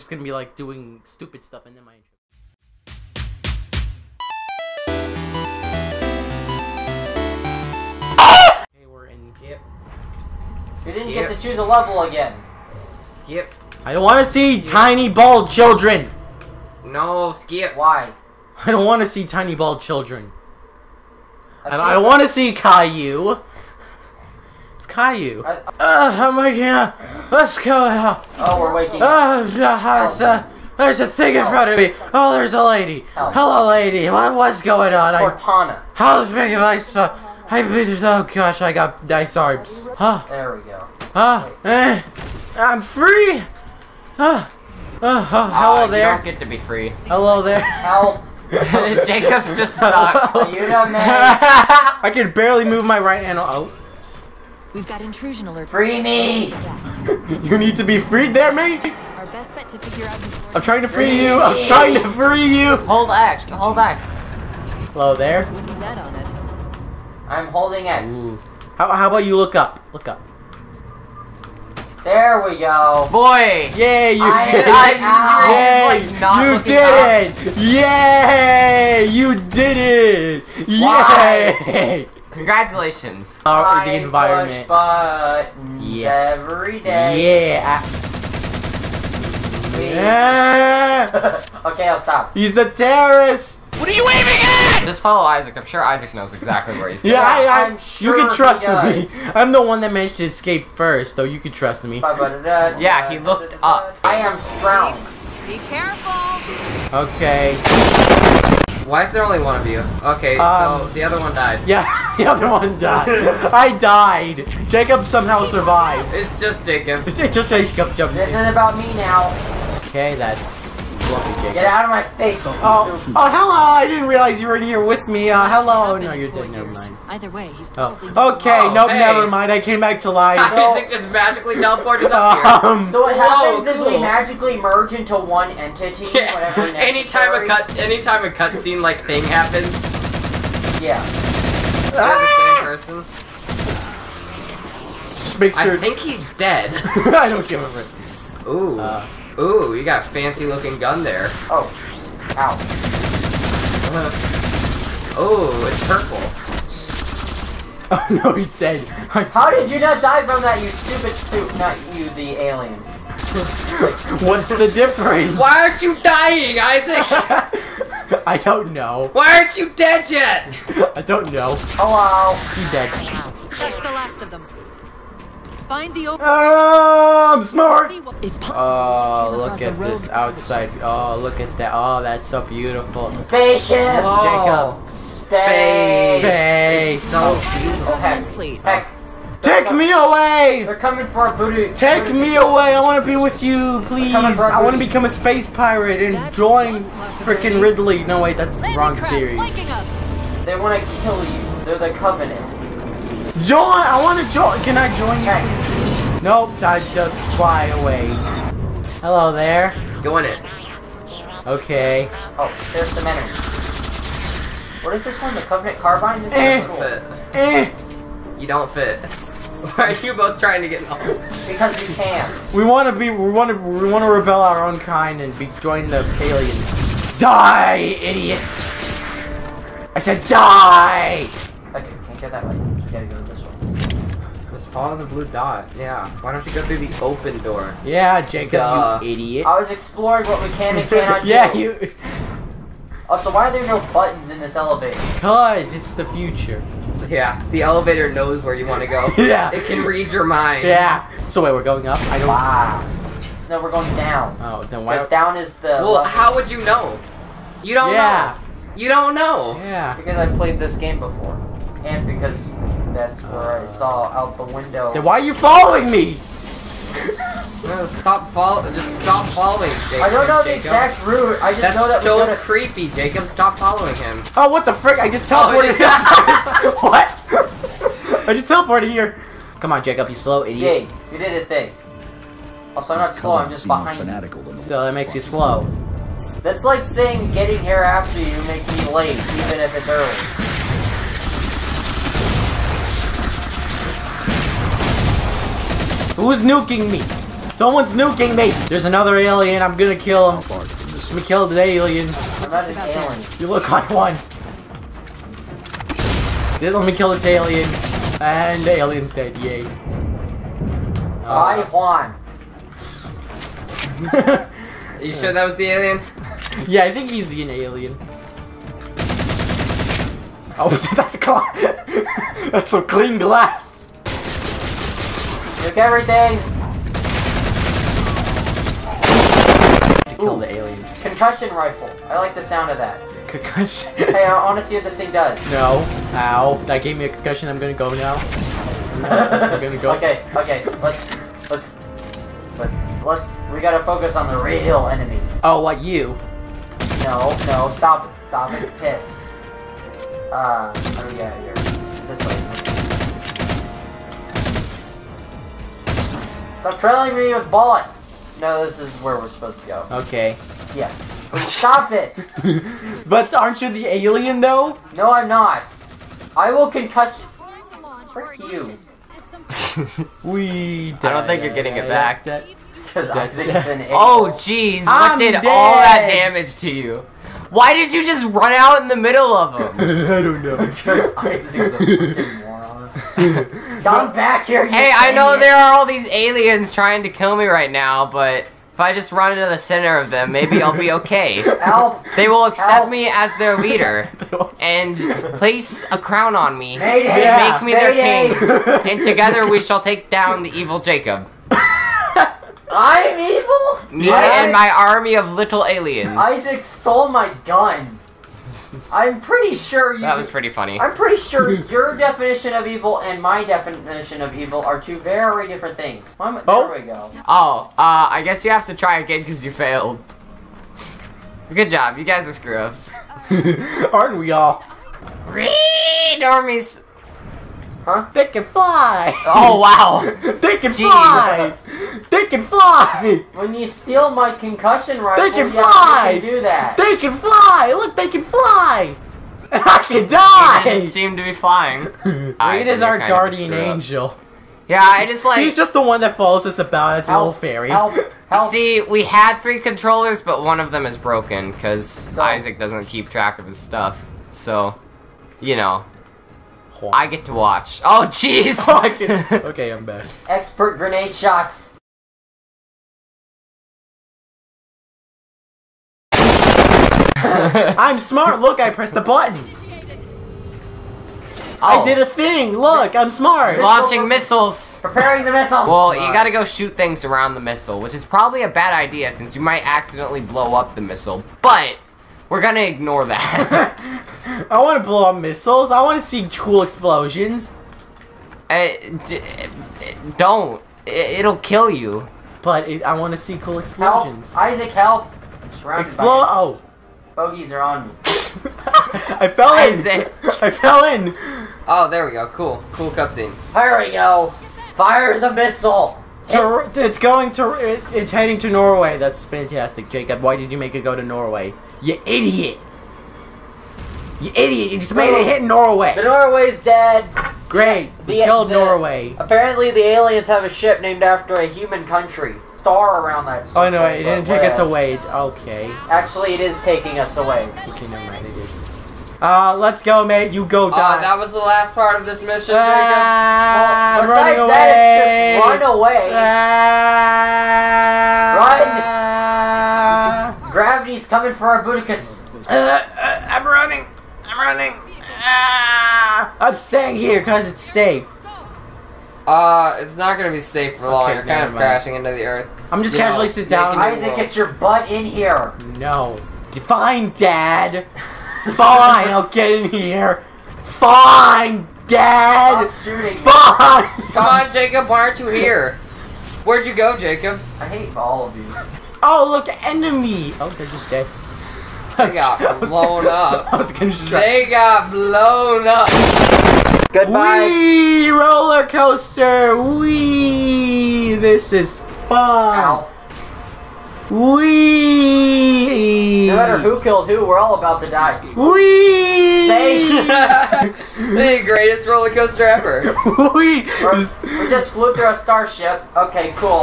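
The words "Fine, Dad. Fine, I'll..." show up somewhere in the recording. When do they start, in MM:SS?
09:16.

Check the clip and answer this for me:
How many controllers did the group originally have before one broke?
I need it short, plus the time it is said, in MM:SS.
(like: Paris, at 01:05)
3, at 07:29.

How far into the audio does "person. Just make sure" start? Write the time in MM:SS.
02:23.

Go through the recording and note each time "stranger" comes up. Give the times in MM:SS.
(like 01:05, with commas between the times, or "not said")
not said.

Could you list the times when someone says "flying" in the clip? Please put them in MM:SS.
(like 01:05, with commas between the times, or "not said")
07:21.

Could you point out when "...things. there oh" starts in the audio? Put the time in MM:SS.
06:55.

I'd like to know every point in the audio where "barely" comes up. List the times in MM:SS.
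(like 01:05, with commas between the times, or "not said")
00:52.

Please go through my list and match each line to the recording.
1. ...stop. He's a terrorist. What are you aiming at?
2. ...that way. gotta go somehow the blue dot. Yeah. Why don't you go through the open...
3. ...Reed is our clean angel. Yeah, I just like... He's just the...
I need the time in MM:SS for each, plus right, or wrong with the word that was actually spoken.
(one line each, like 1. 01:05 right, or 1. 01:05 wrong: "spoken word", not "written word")
1. 01:31 right
2. 03:52 wrong: "follow", not "somehow"
3. 07:22 wrong: "guardian", not "clean".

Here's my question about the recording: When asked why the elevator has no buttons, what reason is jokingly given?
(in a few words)
it's the future.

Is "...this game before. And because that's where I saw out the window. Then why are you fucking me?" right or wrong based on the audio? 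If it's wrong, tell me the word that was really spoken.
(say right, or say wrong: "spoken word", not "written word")
wrong: "following", not "fucking".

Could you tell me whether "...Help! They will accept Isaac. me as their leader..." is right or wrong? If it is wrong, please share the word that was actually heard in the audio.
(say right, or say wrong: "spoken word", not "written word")
wrong: "Help", not "Isaac".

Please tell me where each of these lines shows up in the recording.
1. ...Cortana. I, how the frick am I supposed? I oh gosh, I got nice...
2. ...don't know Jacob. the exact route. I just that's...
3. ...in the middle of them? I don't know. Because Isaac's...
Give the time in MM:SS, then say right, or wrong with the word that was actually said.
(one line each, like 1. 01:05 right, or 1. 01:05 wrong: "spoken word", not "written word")
1. 00:35 right
2. 04:30 right
3. 06:18 right.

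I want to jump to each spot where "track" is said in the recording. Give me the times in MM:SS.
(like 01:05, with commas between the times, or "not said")
07:33.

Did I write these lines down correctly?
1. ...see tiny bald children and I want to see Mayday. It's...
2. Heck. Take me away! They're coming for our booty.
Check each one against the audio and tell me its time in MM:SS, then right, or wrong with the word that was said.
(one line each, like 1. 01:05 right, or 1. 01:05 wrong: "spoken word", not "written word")
1. 00:19 wrong: "Caillou", not "Mayday"
2. 03:08 right.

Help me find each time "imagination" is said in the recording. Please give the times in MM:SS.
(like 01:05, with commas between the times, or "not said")
not said.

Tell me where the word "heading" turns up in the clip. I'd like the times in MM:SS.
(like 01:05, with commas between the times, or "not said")
08:28.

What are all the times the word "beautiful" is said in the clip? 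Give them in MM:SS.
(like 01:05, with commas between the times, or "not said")
03:02, 03:07.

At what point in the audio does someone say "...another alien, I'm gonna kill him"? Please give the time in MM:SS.
04:58.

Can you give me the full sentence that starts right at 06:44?
and my army of little aliens.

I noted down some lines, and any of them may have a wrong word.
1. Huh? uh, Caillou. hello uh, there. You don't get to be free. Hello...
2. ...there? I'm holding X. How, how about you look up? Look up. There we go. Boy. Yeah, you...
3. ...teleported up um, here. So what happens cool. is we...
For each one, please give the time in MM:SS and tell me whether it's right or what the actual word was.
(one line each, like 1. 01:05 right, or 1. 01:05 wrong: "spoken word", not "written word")
1. 00:44 wrong: "Huh", not "Caillou"
2. 01:05 right
3. 02:11 right.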